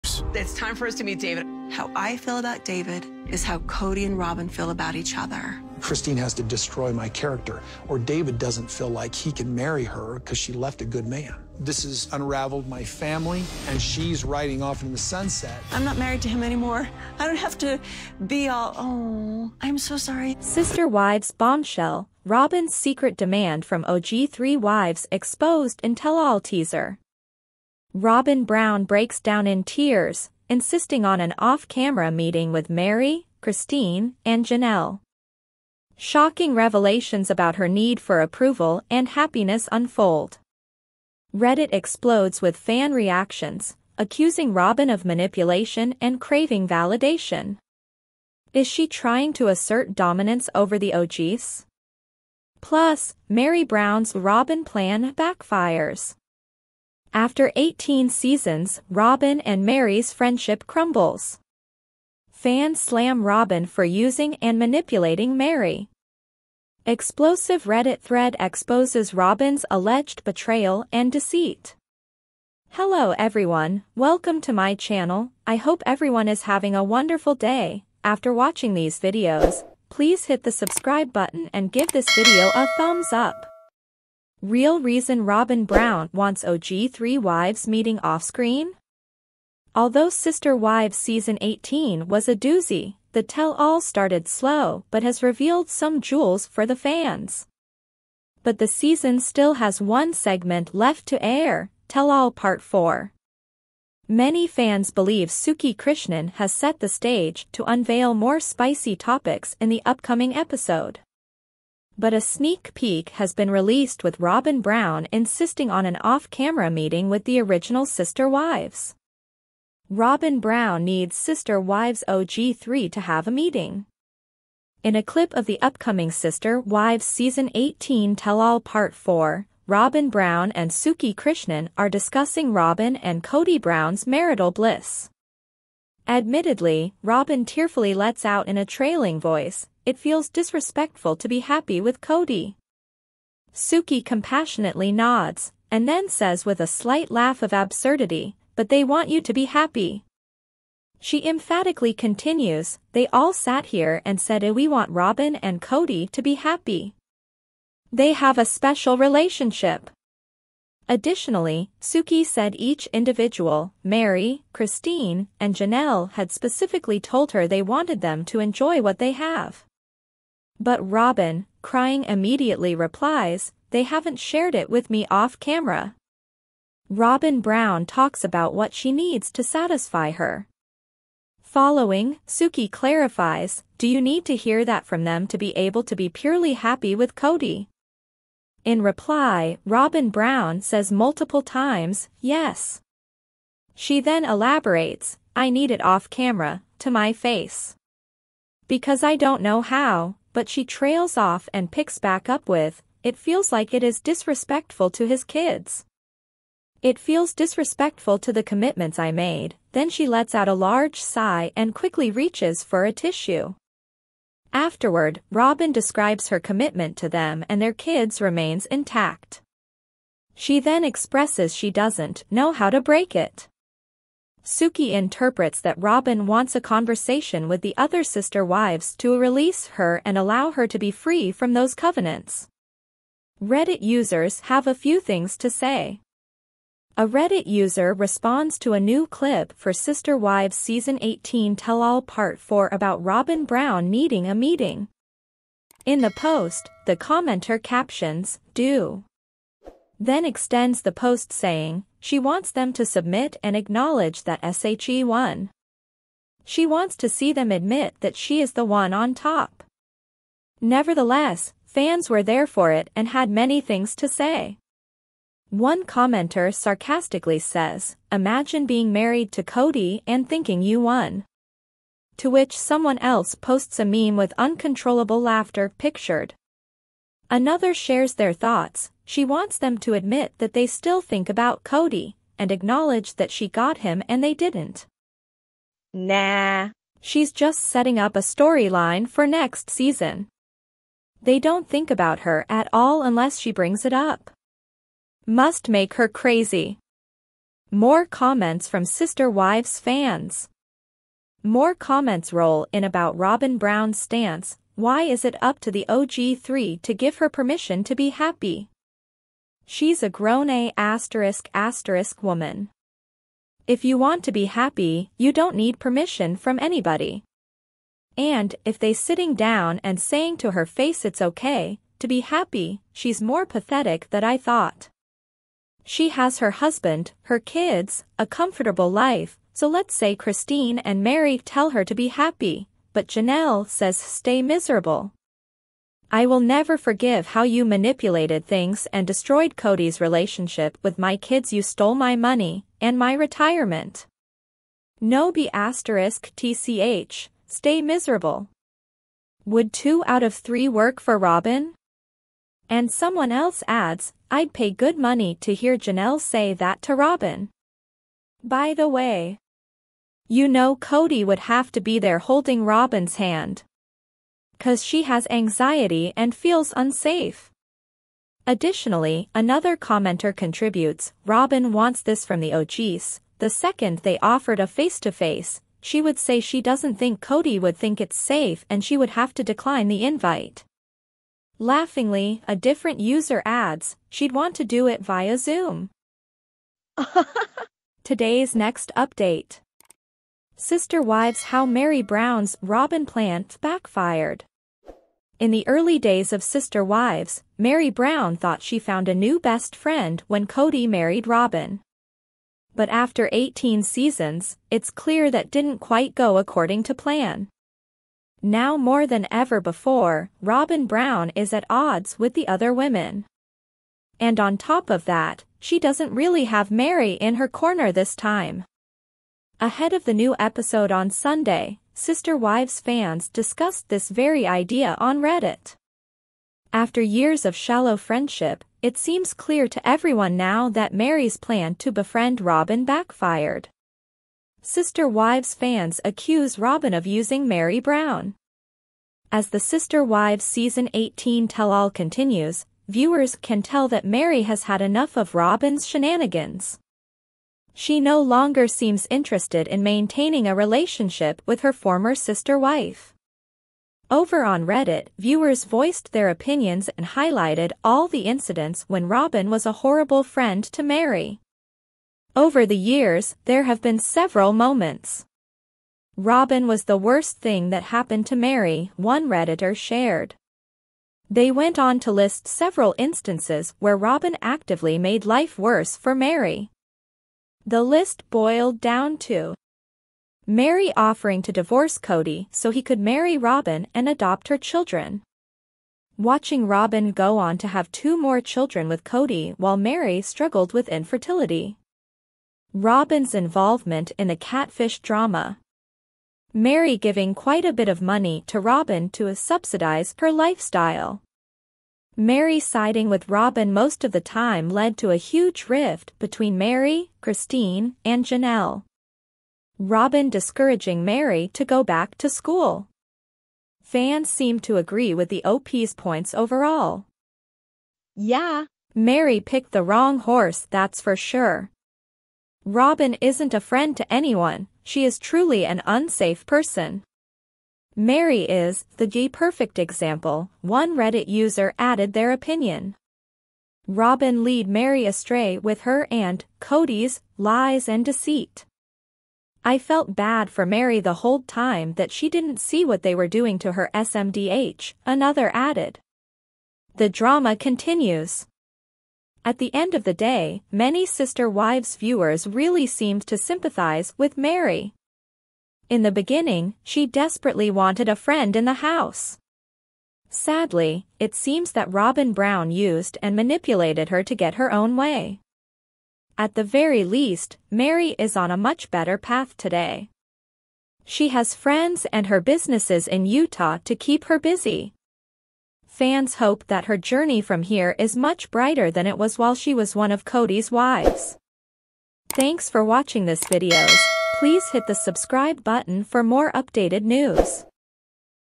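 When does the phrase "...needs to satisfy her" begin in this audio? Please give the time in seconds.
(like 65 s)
178 s.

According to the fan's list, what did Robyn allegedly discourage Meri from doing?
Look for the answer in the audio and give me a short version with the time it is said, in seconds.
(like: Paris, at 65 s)
go back to school, at 511 s.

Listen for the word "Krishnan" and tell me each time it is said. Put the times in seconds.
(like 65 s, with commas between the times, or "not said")
105 s, 131 s.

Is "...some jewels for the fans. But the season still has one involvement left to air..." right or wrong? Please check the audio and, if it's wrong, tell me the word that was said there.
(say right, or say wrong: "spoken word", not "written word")
wrong: "segment", not "involvement".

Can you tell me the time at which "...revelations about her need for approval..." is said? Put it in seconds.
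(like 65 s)
36 s.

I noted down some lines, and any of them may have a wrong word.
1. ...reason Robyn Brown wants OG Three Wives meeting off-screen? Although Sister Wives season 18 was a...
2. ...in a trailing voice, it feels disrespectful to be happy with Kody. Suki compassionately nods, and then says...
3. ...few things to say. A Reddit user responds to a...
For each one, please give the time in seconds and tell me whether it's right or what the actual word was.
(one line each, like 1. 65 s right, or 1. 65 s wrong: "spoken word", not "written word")
1. 84 s right
2. 138 s right
3. 234 s right.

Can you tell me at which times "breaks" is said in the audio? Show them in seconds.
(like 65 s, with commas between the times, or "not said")
28 s, 222 s.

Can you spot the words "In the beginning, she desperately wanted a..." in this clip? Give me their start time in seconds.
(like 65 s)
555 s.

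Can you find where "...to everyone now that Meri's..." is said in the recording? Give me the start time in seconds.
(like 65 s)
429 s.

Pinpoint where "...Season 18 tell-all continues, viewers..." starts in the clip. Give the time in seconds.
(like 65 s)
440 s.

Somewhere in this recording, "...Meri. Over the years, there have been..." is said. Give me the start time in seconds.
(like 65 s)
460 s.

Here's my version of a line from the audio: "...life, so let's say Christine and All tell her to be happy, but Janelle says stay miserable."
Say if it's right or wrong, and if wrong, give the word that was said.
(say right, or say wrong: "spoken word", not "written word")
wrong: "Meri", not "All".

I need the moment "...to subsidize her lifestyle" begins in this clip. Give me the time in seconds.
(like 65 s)
499 s.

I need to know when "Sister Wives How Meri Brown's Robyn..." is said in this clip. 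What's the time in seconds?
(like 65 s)
390 s.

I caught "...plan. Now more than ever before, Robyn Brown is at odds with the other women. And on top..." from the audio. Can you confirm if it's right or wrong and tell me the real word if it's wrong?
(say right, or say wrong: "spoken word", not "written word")
right.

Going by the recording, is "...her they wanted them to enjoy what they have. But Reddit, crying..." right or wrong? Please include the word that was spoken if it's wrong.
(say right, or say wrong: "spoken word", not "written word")
wrong: "Robyn", not "Reddit".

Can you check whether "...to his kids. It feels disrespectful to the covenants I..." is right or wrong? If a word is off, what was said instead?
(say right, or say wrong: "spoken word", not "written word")
wrong: "commitments", not "covenants".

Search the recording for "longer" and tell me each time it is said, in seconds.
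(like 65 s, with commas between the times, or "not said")
448 s.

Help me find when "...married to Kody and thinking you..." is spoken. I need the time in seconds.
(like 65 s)
268 s.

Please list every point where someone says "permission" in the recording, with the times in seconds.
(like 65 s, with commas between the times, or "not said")
307 s, 315 s.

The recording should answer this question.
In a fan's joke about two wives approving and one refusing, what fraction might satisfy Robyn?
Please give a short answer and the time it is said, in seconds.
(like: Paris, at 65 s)
Two out of three, at 349 s.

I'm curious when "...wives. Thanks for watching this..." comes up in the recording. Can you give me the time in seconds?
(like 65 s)
580 s.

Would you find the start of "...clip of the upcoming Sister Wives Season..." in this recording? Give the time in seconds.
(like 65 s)
125 s.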